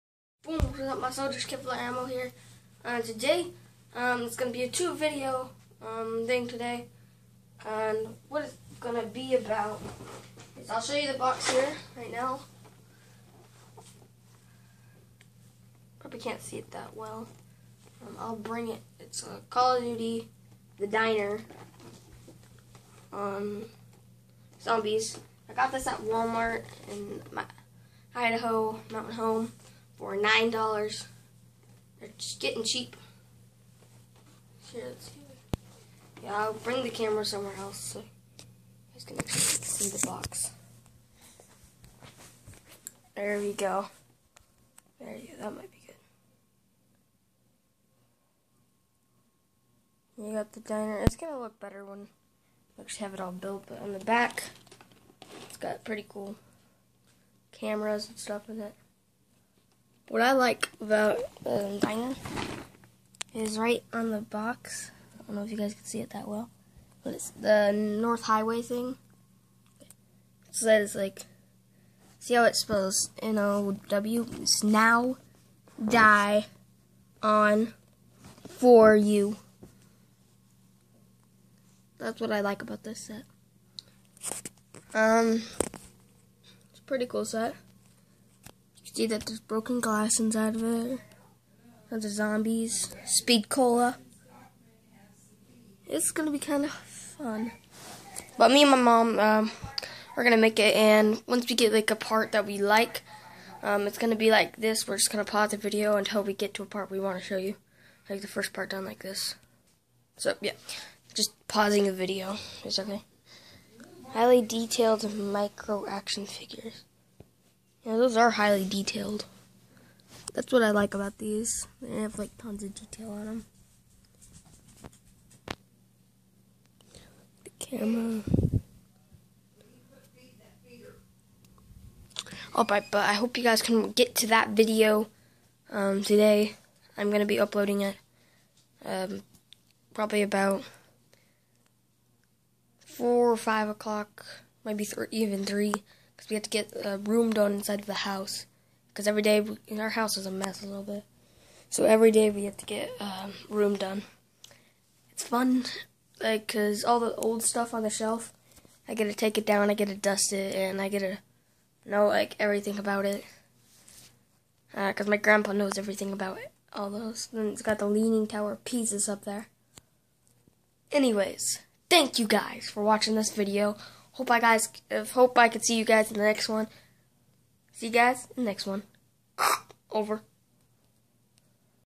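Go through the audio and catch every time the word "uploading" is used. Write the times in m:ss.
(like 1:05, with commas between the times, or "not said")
2:17.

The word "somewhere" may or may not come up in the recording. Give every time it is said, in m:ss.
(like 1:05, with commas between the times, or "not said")
0:37.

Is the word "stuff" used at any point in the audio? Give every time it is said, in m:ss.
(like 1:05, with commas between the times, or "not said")
0:58, 2:37.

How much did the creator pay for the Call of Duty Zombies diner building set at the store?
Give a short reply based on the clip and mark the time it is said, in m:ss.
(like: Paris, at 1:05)
$9, at 0:30.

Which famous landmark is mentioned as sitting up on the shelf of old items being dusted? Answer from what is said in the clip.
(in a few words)
Leaning Tower of Pisa.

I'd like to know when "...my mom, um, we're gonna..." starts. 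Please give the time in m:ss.
1:38.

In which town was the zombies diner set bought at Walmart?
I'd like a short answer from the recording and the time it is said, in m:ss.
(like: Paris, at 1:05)
Mountain Home, at 0:28.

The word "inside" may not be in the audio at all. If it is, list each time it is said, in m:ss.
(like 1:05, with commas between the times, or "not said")
1:30, 2:27.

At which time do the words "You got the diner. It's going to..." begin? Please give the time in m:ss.
0:50.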